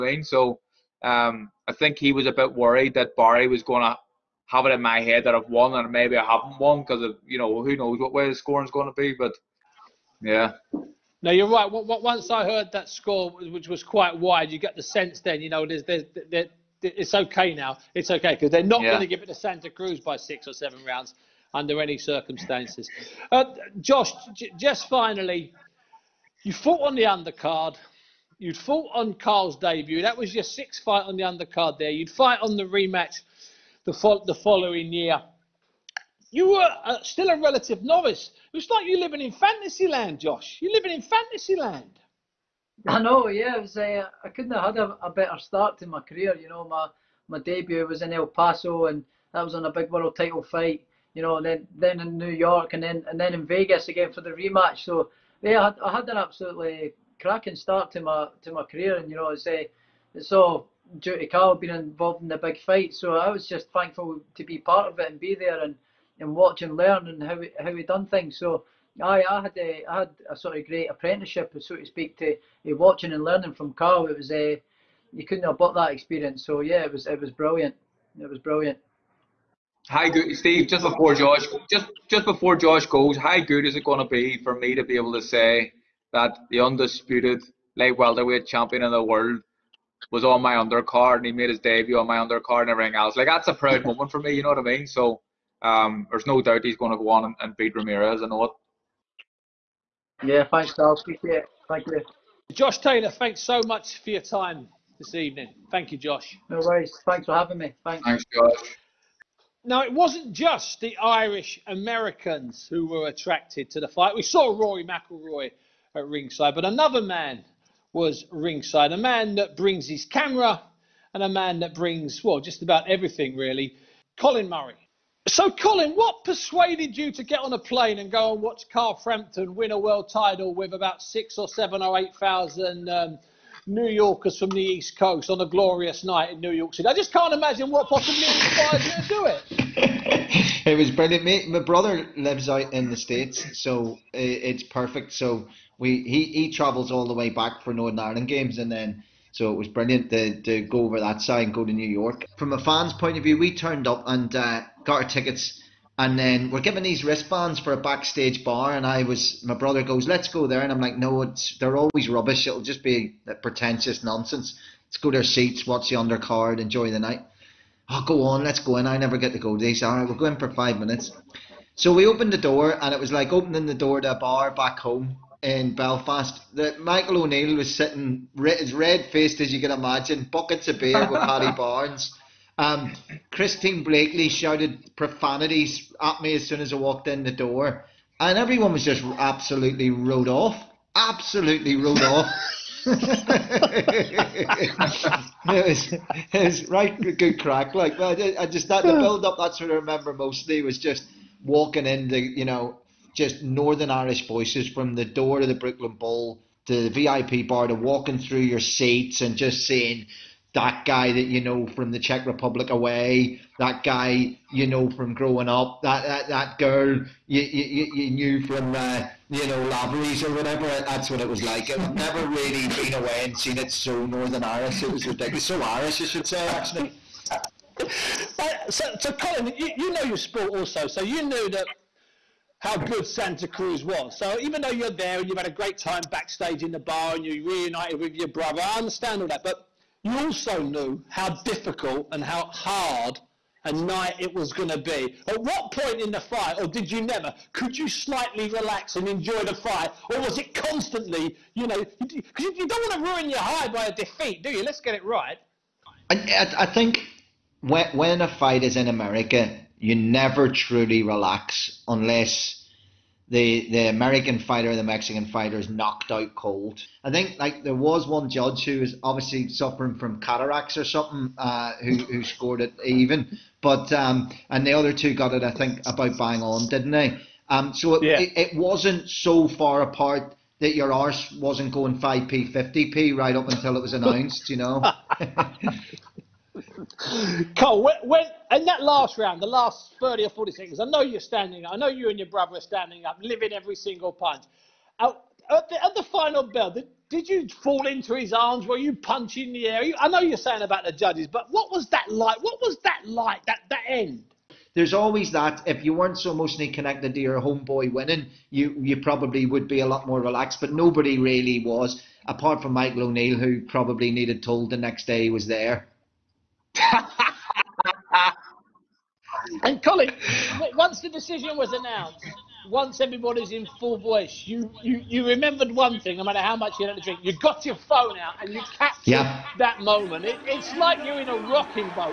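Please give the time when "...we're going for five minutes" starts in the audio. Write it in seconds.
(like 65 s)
170 s.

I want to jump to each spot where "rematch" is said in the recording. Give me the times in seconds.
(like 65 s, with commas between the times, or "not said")
32 s, 54 s.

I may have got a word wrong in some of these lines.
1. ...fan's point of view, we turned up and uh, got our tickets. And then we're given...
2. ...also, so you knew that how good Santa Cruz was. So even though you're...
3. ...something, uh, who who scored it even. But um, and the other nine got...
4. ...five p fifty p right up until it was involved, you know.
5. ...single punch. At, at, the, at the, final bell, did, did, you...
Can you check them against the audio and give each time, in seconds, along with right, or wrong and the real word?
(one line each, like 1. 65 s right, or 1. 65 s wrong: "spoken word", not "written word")
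1. 152 s right
2. 230 s right
3. 270 s wrong: "two", not "nine"
4. 281 s wrong: "announced", not "involved"
5. 293 s right.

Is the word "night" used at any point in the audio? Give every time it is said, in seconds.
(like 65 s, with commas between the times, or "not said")
136 s, 166 s, 243 s.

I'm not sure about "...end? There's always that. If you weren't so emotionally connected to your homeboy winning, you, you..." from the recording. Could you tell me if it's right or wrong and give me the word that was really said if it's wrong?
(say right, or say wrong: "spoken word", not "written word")
right.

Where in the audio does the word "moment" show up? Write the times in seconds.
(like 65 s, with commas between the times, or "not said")
93 s, 329 s.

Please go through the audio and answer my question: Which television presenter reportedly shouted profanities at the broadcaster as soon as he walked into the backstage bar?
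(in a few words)
Christine Bleakley.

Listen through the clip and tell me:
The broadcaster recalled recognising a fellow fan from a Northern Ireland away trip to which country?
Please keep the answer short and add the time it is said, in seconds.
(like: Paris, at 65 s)
Czech Republic, at 211 s.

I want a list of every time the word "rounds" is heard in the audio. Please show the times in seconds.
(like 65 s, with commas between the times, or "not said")
20 s, 289 s.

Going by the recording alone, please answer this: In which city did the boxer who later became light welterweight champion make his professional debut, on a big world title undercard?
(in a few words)
El Paso.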